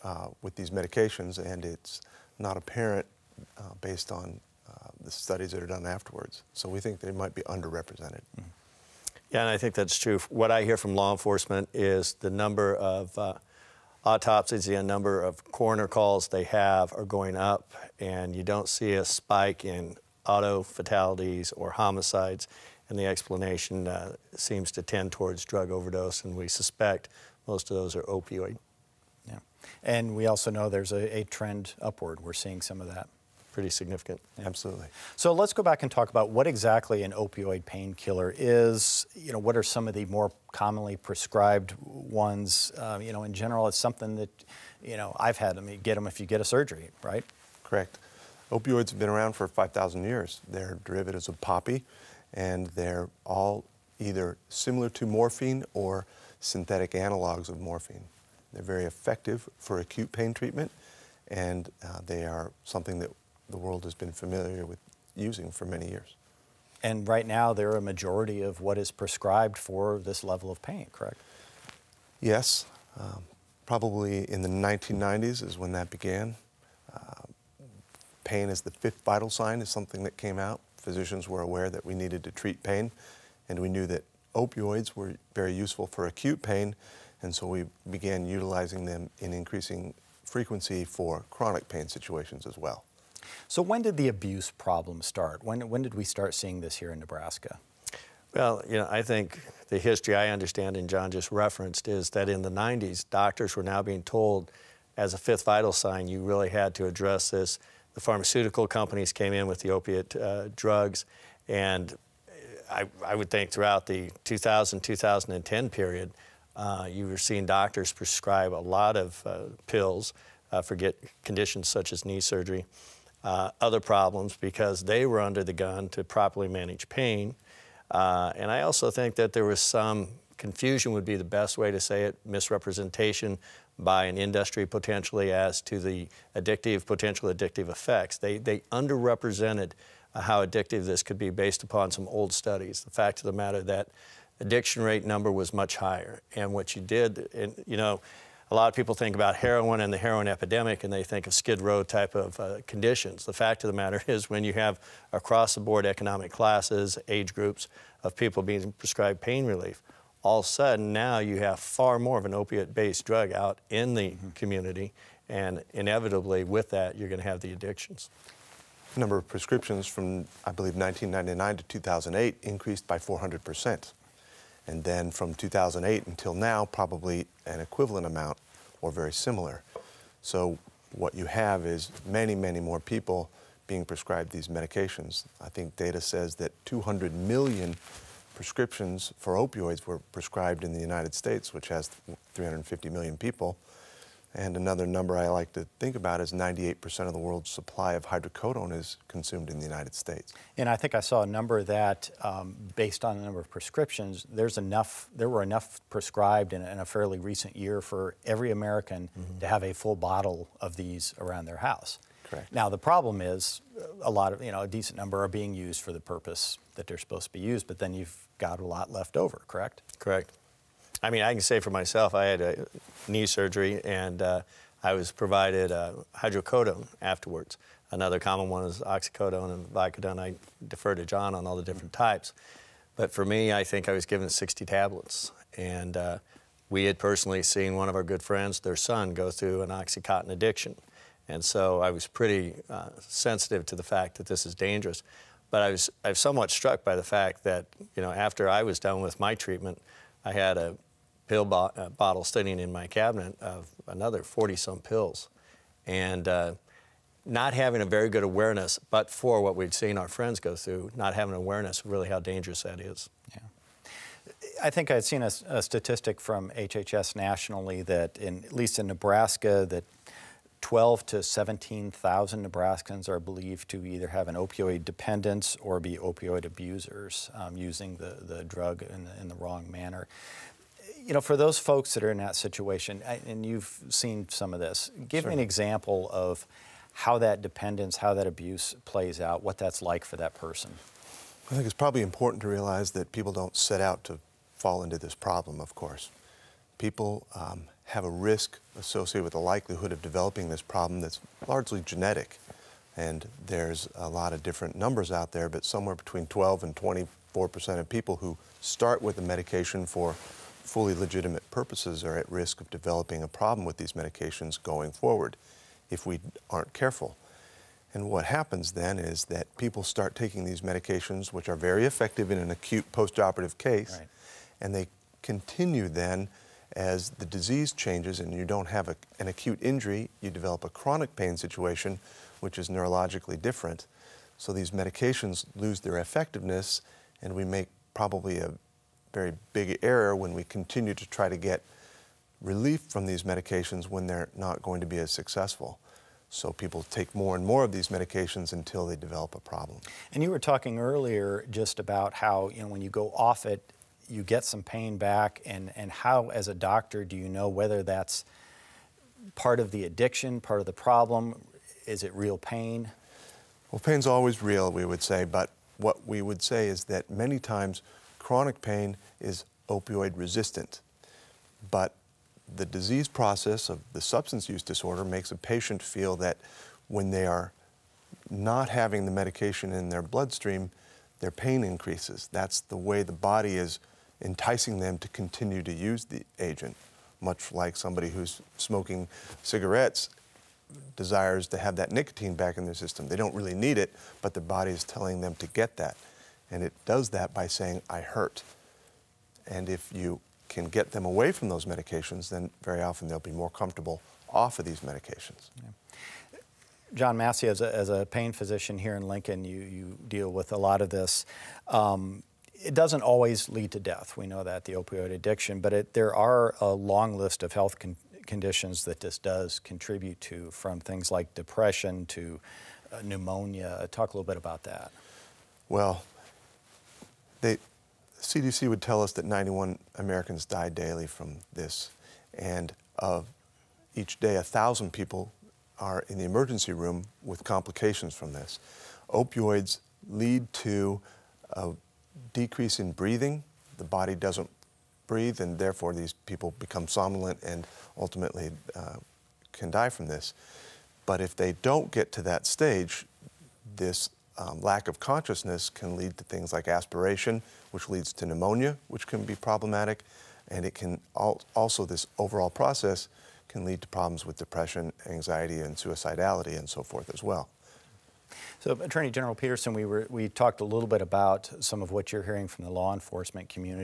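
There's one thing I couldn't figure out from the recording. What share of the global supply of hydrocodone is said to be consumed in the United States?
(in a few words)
98%.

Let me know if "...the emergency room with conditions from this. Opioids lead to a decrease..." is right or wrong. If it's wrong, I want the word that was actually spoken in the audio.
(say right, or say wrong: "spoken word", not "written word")
wrong: "complications", not "conditions".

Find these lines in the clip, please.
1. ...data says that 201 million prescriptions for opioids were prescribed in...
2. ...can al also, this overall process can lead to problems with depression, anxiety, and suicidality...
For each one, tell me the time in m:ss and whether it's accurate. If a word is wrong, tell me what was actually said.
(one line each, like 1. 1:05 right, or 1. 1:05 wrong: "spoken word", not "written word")
1. 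3:05 wrong: "200", not "201"
2. 7:40 right.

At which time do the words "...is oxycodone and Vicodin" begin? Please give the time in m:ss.
3:48.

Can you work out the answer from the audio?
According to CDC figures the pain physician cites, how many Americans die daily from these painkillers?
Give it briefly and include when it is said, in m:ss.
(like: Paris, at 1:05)
91, at 7:09.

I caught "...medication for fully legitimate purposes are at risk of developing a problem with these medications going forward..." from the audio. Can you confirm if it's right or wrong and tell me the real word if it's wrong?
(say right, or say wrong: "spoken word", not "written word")
right.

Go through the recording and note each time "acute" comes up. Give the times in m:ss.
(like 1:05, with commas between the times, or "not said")
0:59, 1:26, 5:22, 5:29.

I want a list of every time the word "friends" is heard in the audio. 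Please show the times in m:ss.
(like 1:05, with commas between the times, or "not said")
3:58, 4:20.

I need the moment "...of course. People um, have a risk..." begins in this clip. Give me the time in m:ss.
4:55.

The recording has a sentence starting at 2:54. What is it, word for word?
And then from 2008 until now, probably an equivalent amount or very similar.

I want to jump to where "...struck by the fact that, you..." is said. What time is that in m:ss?
4:06.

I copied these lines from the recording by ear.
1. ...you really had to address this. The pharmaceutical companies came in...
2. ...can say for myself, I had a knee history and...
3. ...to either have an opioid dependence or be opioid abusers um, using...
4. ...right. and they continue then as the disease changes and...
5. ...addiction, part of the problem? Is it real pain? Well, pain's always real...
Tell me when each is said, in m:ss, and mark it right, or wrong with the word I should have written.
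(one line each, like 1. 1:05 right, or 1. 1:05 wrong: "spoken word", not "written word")
1. 1:46 right
2. 3:41 wrong: "surgery", not "history"
3. 4:33 right
4. 5:23 right
5. 5:59 right.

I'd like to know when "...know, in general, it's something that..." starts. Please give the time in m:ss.
0:43.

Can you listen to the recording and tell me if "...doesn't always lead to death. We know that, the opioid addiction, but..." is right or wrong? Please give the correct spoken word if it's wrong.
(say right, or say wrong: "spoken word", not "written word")
right.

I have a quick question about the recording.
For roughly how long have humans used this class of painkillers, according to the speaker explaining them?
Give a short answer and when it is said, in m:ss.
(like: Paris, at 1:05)
5,000 years, at 0:49.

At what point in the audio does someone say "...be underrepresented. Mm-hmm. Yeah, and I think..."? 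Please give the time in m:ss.
0:07.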